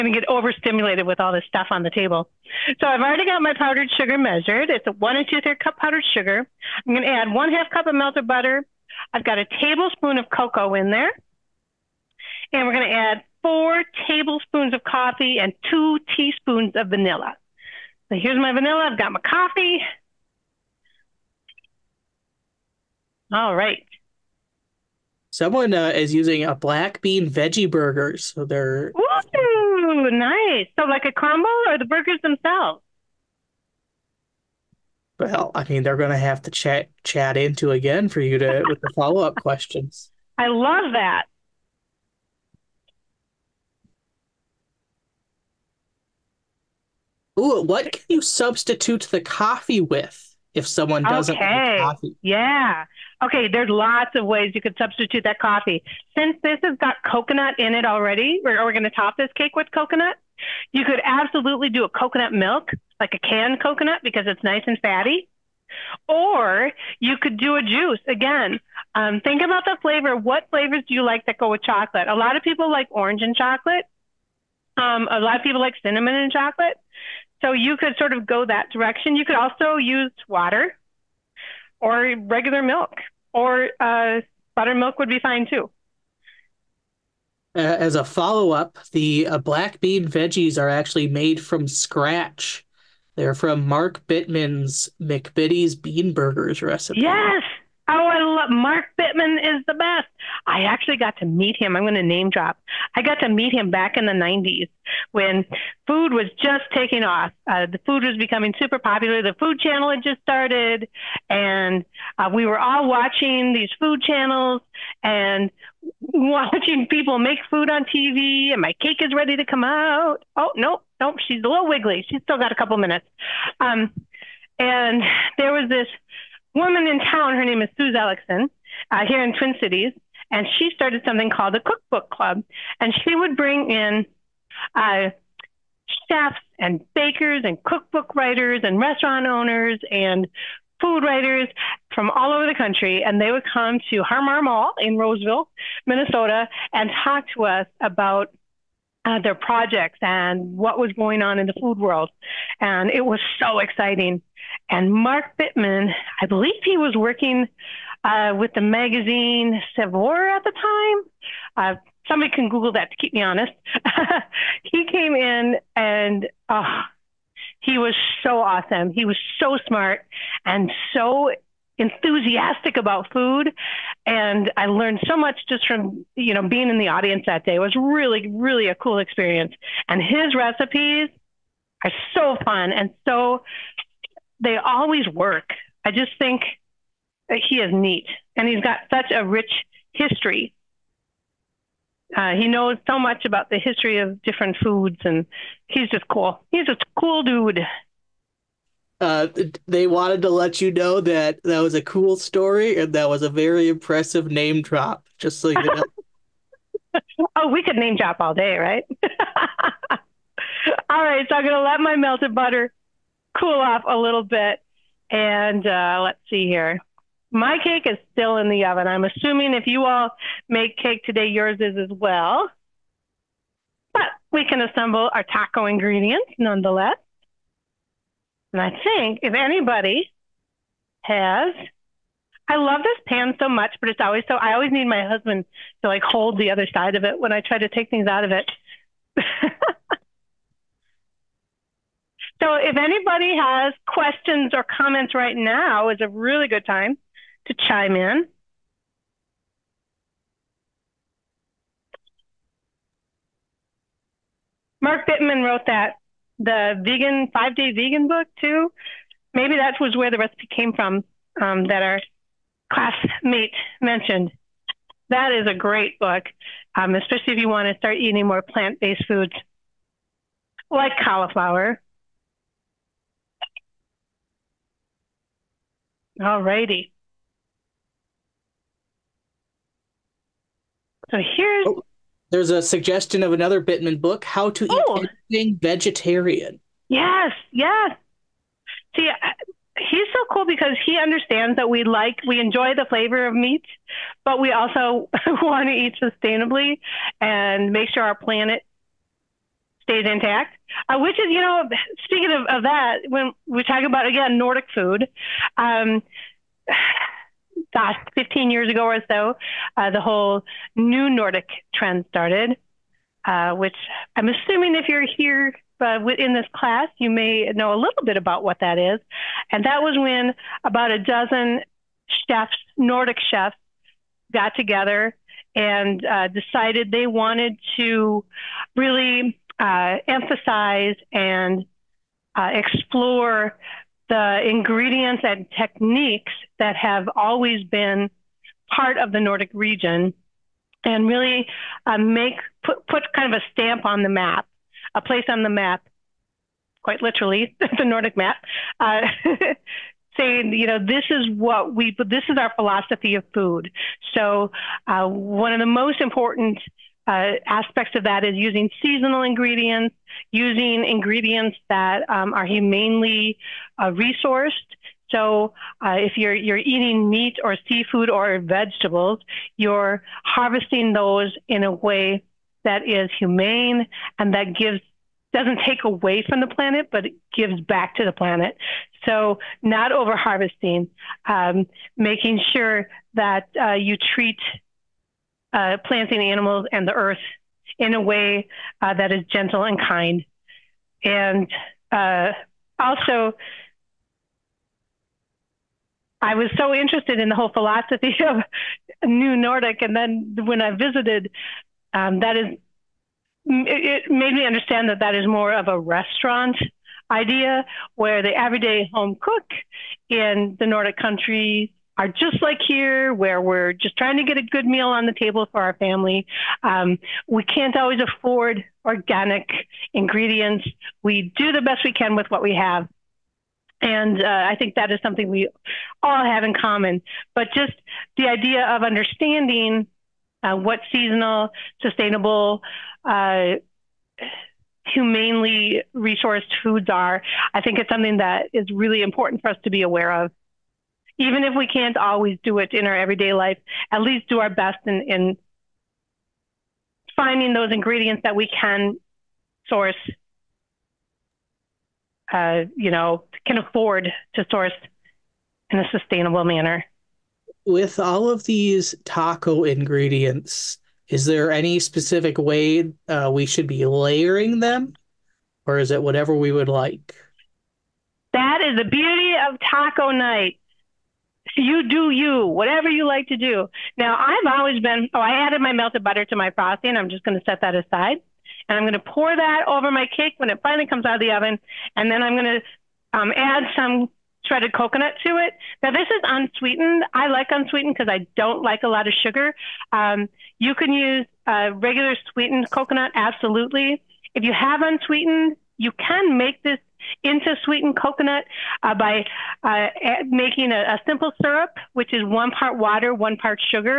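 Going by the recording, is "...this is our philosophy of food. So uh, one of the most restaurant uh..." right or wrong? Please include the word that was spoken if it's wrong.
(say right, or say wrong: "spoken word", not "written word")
wrong: "important", not "restaurant".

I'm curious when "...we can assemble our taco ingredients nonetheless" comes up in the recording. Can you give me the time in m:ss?
3:44.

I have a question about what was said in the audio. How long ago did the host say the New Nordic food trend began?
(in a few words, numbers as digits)
15 years.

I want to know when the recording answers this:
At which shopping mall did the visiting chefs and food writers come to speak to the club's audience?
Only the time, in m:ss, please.
2:24.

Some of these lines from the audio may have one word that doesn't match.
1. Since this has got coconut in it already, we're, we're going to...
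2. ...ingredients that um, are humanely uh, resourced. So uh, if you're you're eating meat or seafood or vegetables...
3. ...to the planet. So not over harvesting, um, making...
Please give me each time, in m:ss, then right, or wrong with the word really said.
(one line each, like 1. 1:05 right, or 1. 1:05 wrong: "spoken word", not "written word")
1. 0:56 right
2. 6:00 right
3. 6:17 right.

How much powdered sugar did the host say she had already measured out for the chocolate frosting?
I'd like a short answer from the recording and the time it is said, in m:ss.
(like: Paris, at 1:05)
1 2/3 cups, at 0:04.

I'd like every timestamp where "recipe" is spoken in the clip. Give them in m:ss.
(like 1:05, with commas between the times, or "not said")
1:36, 3:00, 4:20.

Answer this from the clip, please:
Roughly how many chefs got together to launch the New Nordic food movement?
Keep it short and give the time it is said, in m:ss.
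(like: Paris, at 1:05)
a dozen, at 5:20.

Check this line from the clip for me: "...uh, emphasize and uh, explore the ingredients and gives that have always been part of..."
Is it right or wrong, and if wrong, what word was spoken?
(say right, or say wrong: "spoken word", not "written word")
wrong: "techniques", not "gives".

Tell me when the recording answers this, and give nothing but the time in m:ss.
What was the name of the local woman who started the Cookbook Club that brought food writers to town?
2:07.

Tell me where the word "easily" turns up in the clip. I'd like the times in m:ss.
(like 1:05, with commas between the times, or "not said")
not said.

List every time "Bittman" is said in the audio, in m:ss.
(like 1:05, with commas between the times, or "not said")
1:34, 1:38, 2:35, 4:15, 4:43.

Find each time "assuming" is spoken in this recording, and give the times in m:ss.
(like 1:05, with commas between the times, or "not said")
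3:39, 5:14.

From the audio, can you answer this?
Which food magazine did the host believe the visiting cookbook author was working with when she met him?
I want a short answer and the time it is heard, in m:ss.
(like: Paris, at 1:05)
Saveur, at 2:39.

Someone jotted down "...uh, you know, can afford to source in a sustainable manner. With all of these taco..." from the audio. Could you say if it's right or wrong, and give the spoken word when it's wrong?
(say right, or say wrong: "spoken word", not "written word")
right.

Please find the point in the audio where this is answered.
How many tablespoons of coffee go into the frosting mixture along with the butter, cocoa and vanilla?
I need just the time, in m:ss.
0:13.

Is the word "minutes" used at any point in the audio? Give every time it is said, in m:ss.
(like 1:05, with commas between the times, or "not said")
2:02.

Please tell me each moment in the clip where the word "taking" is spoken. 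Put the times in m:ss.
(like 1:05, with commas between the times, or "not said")
1:46.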